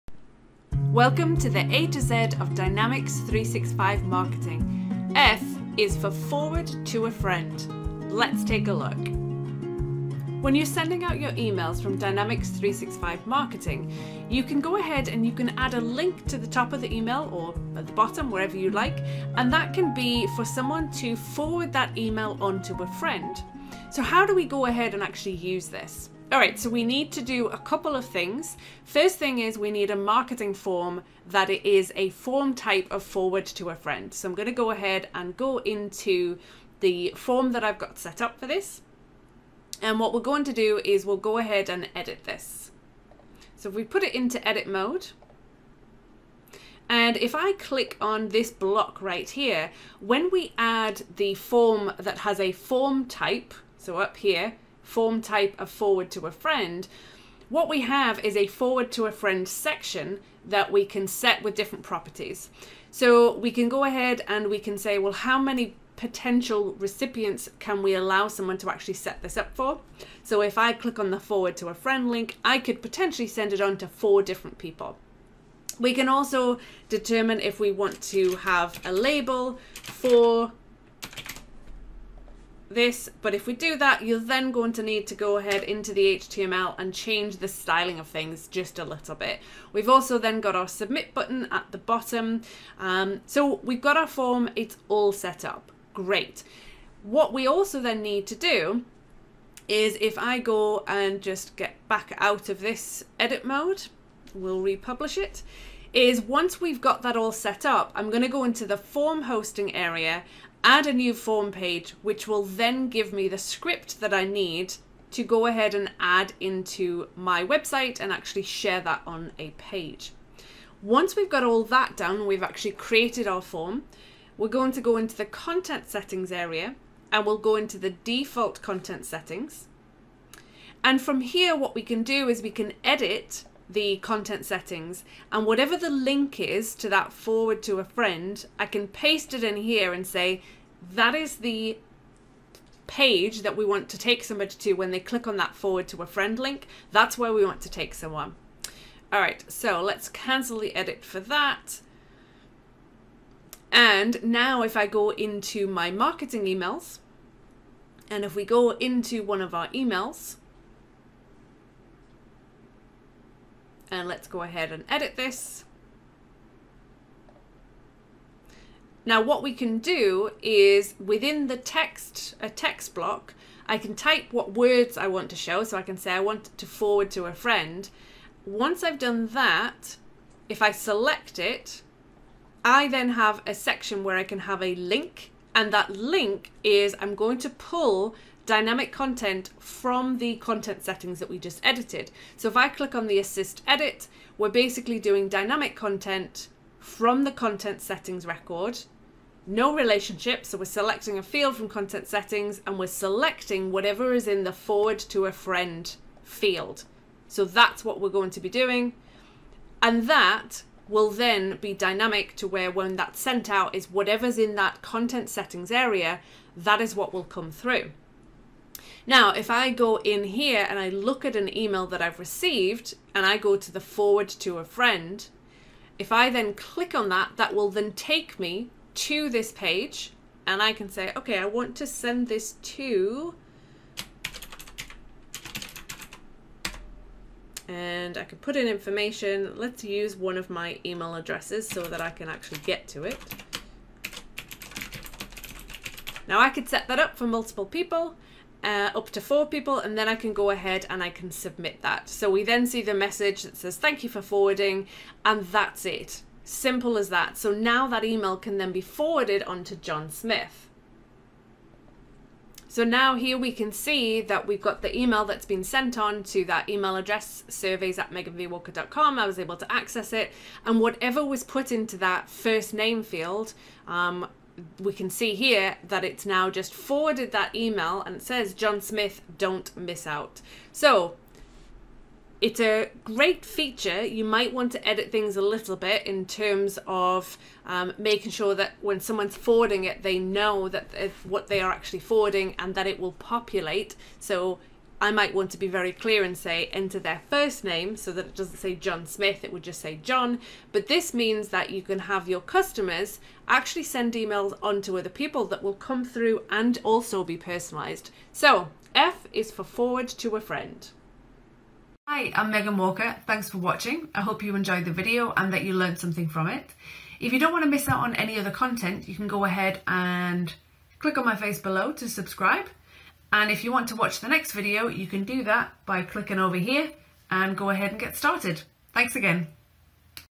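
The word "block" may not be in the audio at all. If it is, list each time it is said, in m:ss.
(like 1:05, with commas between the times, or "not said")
0:48, 2:52.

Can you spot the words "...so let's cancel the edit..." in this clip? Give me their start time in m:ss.
2:29.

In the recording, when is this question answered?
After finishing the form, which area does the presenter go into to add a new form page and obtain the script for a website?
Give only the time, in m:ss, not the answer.
1:48.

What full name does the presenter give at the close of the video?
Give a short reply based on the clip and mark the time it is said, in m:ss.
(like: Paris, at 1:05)
Megan Walker, at 5:12.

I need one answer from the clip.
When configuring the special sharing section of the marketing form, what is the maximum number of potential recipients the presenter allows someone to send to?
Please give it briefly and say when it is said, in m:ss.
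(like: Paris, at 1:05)
4, at 1:13.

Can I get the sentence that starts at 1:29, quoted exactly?
We've also then got our submit button at the bottom.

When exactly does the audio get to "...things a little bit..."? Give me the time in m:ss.
4:45.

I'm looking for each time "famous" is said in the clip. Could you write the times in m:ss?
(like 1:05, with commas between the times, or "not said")
not said.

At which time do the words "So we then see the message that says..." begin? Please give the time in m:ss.
4:12.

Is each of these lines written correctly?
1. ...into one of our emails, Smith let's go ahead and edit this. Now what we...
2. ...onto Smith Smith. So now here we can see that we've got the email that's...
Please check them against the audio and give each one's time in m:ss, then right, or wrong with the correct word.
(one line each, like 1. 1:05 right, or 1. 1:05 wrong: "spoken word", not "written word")
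1. 2:38 wrong: "And", not "Smith"
2. 4:19 wrong: "John", not "Smith".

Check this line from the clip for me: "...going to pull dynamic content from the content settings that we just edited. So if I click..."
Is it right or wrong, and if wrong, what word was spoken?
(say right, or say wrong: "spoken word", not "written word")
right.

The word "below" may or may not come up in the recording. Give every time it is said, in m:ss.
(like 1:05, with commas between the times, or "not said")
5:21.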